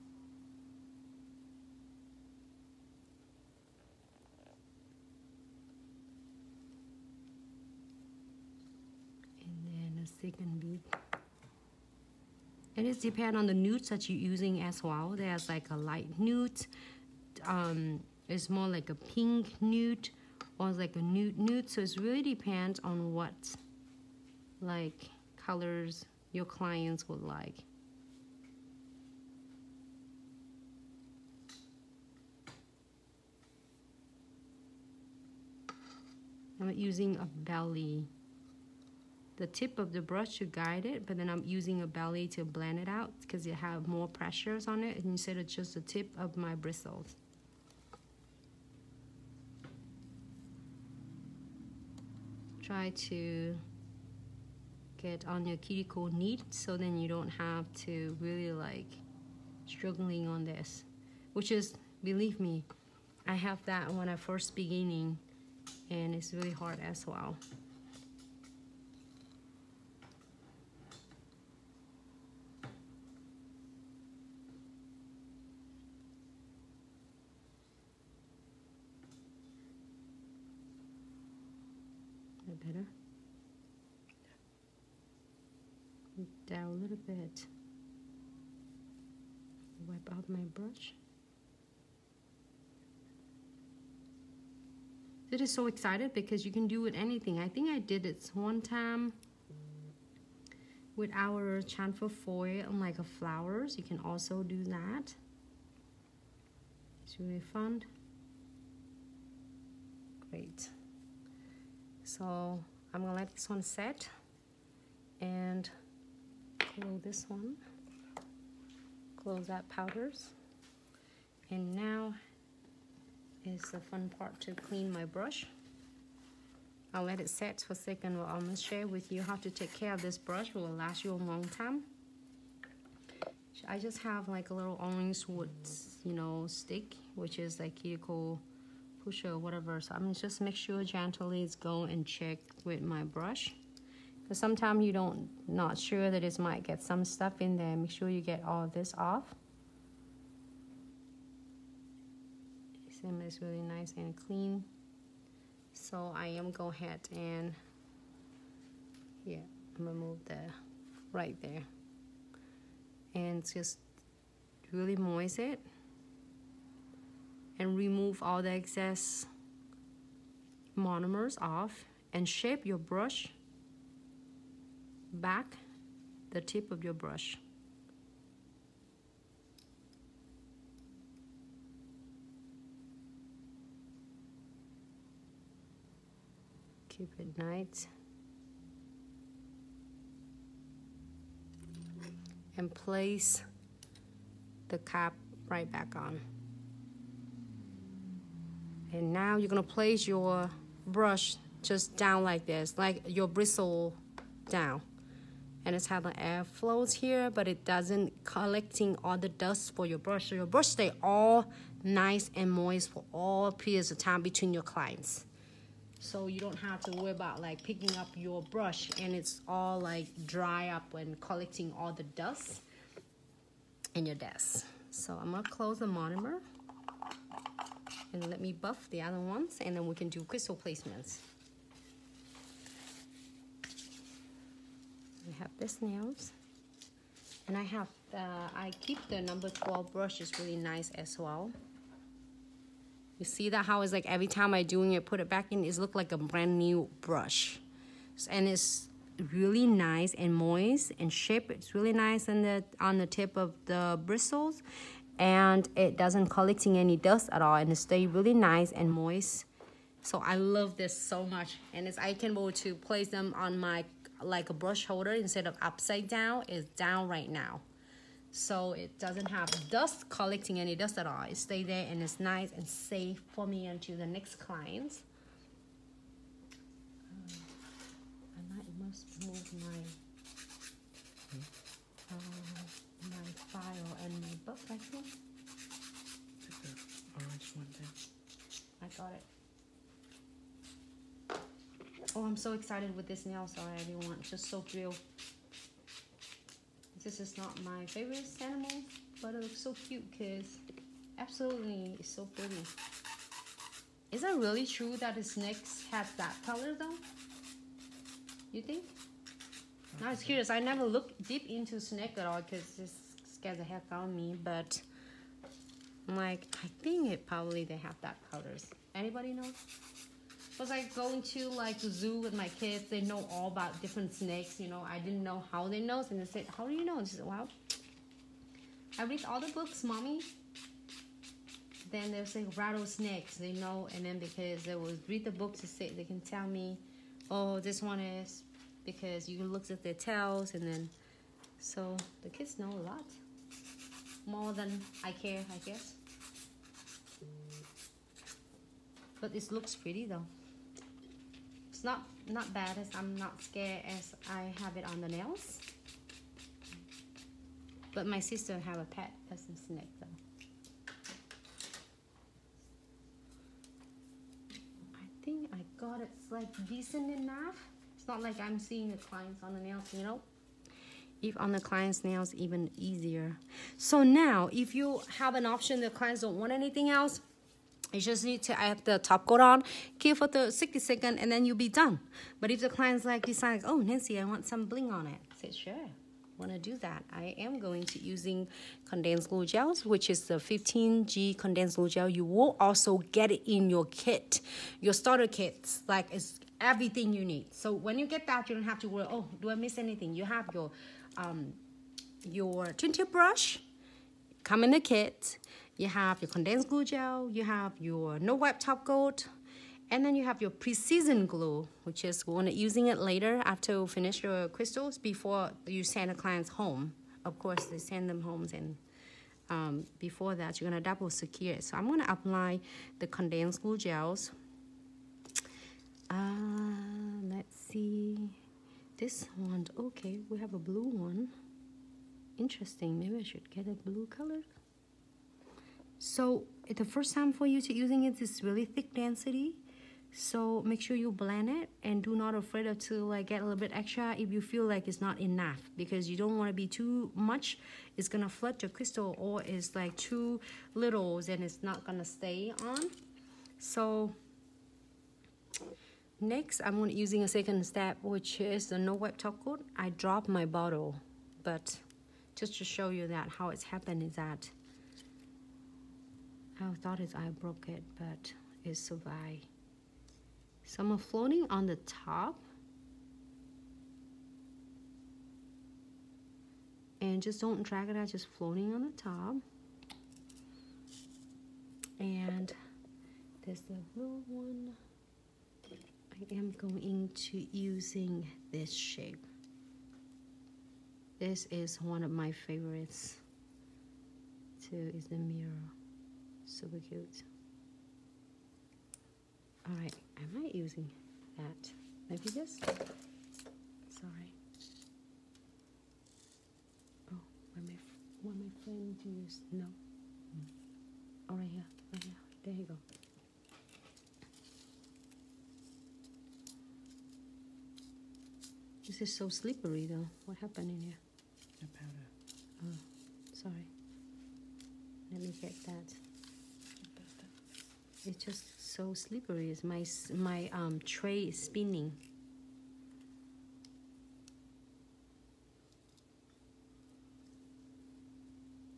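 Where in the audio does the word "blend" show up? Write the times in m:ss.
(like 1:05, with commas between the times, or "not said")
0:42, 7:21.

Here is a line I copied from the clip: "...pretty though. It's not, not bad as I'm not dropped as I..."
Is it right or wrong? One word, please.
wrong.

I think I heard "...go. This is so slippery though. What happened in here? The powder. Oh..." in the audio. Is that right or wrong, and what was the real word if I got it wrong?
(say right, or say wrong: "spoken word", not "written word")
right.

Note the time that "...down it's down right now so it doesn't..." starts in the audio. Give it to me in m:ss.
4:26.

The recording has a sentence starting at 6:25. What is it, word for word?
I say, sure, want to do that.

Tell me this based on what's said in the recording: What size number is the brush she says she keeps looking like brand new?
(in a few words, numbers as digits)
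12.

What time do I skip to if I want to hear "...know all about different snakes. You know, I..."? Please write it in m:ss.
5:23.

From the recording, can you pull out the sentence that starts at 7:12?
Interesting, maybe I should get a blue color.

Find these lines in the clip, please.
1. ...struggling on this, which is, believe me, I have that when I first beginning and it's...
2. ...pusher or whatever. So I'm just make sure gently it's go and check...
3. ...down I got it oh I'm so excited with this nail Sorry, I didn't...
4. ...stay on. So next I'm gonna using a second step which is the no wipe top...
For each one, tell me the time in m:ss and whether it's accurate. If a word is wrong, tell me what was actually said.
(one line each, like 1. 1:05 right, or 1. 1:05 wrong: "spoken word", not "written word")
1. 0:59 right
2. 2:19 right
3. 4:47 right
4. 7:32 right.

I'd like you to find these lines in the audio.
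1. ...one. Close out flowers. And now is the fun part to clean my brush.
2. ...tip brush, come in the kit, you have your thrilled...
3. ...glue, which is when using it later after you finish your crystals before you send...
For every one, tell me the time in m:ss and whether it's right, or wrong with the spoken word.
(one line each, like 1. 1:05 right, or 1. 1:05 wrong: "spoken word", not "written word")
1. 1:57 wrong: "powders", not "flowers"
2. 6:42 wrong: "condensed", not "thrilled"
3. 6:51 right.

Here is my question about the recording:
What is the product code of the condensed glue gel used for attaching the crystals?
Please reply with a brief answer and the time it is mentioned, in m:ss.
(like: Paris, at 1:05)
15G, at 6:30.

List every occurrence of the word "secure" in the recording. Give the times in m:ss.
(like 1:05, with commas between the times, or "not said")
7:01.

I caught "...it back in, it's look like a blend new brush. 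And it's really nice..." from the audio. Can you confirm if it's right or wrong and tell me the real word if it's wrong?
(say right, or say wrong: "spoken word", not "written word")
wrong: "brand", not "blend".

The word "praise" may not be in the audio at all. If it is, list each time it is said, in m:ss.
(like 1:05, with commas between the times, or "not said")
not said.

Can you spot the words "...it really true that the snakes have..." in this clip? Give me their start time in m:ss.
5:04.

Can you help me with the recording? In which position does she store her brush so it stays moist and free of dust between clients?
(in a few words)
bristle down.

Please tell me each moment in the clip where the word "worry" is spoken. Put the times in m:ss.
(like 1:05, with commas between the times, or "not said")
3:36, 6:38.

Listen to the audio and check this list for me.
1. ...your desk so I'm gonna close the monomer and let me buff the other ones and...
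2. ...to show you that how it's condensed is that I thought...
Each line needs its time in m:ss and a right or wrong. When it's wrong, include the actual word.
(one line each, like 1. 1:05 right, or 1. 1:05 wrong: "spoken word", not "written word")
1. 3:44 right
2. 7:42 wrong: "happened", not "condensed".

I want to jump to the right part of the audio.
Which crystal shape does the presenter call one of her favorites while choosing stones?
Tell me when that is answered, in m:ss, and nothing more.
8:15.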